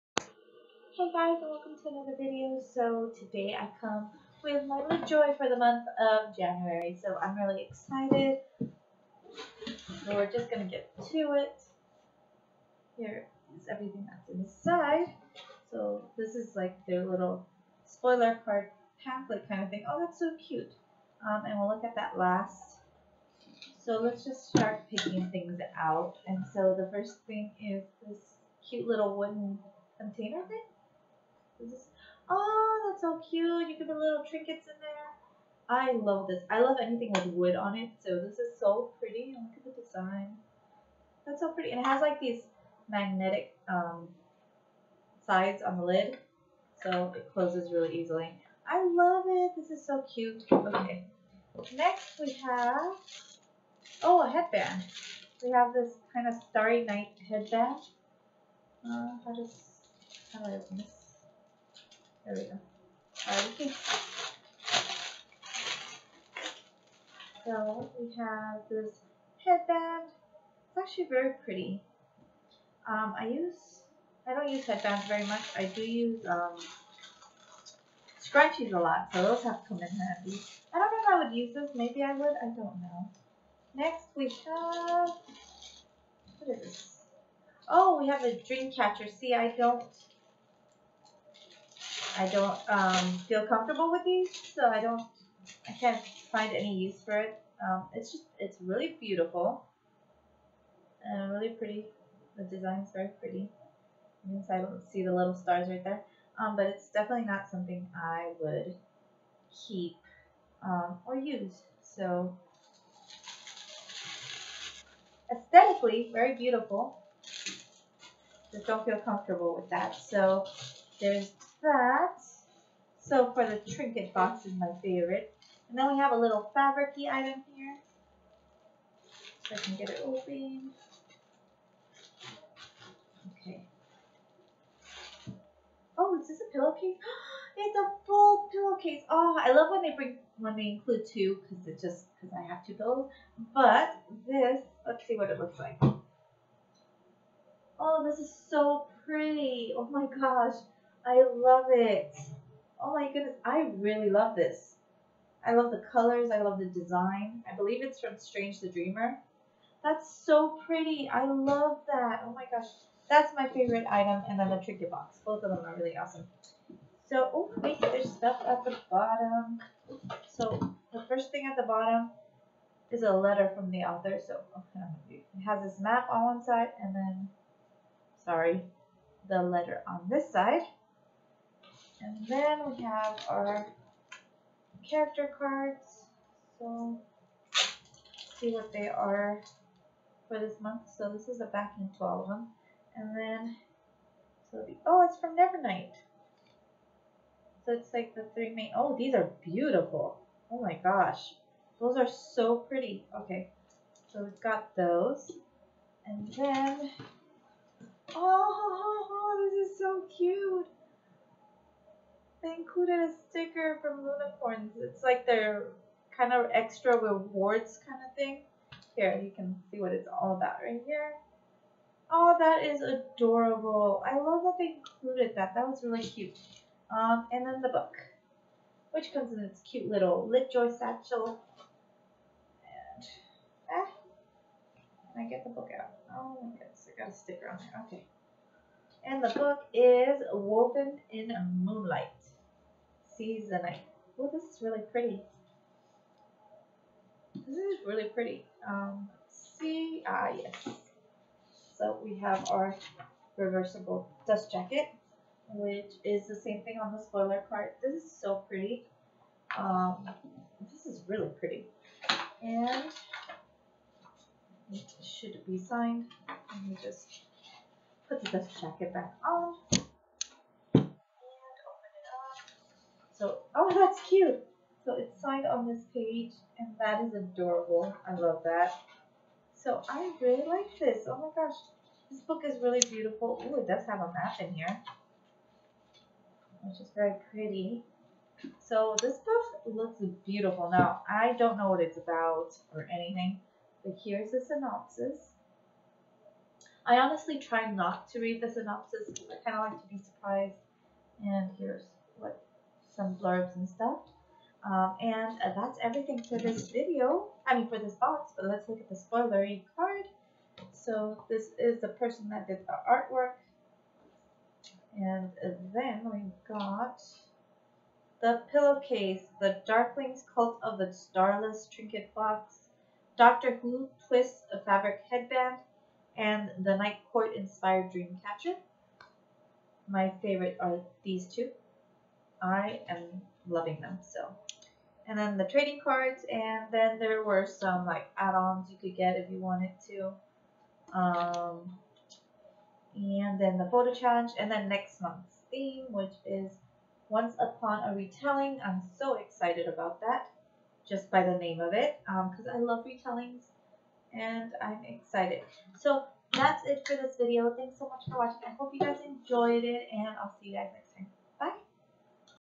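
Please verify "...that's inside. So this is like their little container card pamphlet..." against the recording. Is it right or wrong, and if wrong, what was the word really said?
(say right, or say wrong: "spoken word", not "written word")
wrong: "spoiler", not "container".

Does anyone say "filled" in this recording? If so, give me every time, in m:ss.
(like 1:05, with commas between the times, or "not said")
not said.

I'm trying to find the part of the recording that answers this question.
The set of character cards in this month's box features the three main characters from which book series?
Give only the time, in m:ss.
3:15.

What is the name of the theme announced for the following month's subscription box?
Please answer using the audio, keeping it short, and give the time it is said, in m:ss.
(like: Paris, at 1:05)
Once Upon a Retelling, at 5:47.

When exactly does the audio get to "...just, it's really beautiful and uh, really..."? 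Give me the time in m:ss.
1:38.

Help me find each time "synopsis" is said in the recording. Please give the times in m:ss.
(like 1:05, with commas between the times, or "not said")
4:54, 4:58.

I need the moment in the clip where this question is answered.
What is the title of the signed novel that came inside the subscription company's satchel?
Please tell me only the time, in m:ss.
4:00.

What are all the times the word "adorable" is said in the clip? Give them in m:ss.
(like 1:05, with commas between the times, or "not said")
3:42, 4:37.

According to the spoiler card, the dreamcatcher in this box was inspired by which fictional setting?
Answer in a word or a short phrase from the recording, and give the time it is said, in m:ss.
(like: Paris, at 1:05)
The Night Court, at 5:26.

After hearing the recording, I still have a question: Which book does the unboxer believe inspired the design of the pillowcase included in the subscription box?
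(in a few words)
Strange the Dreamer.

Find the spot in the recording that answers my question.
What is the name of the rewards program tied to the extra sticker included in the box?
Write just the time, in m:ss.
3:34.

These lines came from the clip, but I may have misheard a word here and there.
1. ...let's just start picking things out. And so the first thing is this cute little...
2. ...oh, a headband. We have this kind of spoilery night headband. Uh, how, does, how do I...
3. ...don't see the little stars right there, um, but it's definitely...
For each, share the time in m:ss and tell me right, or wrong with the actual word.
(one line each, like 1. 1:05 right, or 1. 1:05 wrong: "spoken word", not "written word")
1. 0:24 right
2. 0:54 wrong: "starry", not "spoilery"
3. 1:44 right.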